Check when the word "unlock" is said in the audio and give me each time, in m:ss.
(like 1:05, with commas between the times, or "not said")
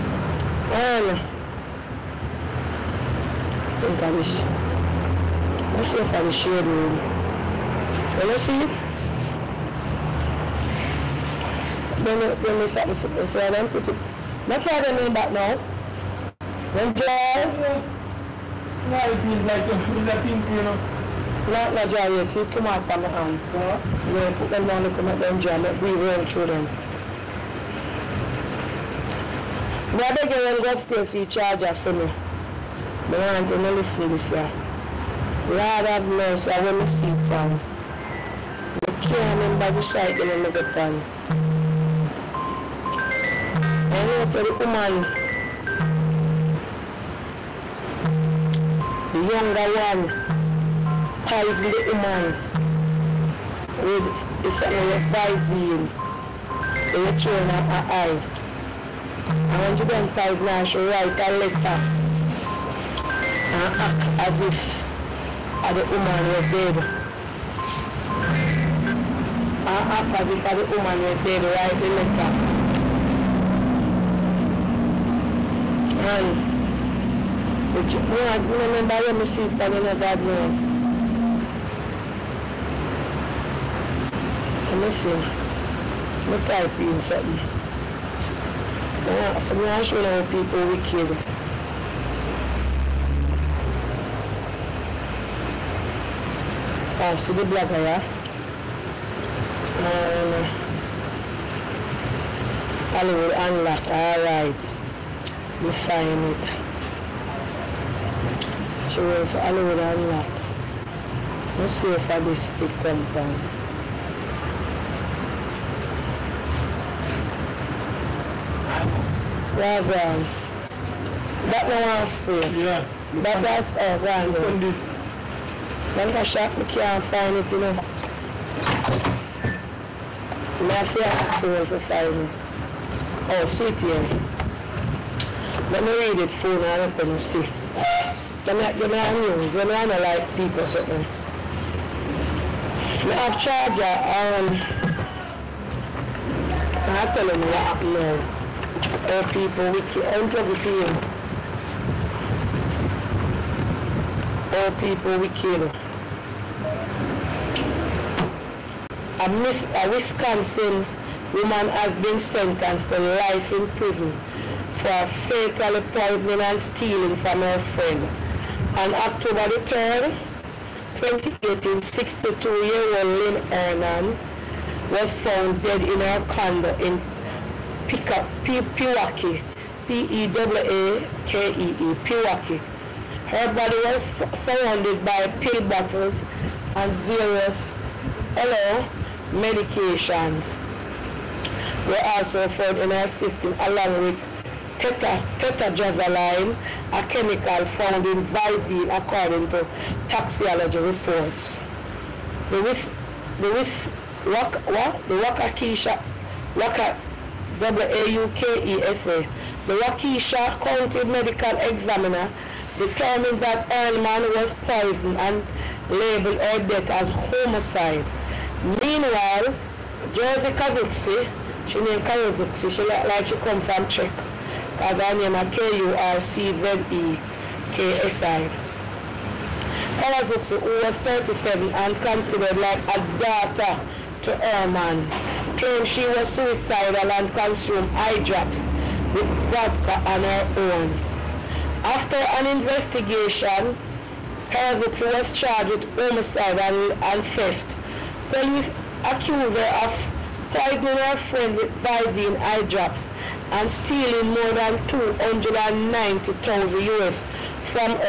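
1:43, 1:49.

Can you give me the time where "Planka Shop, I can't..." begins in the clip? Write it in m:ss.
2:05.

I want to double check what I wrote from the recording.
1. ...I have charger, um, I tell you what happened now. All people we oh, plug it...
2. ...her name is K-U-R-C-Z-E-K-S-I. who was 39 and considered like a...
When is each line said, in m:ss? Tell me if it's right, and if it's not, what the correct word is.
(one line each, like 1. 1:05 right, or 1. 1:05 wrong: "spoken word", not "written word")
1. 2:23 right
2. 3:44 wrong: "37", not "39".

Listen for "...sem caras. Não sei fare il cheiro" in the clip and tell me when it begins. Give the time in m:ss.
0:03.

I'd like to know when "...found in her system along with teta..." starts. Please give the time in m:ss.
3:12.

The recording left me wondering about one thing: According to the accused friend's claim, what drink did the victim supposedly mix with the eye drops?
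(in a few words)
vodka.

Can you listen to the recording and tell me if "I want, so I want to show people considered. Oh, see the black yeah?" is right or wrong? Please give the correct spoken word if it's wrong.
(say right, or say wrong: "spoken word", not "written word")
wrong: "wicked", not "considered".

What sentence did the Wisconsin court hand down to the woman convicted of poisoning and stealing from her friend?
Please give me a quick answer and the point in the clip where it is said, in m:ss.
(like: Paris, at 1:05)
life in prison, at 2:42.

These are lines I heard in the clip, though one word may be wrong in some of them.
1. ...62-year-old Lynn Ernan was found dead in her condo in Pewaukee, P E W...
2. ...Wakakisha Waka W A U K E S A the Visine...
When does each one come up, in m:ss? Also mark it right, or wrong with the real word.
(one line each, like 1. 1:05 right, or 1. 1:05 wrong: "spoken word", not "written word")
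1. 2:51 right
2. 3:25 wrong: "County", not "Visine".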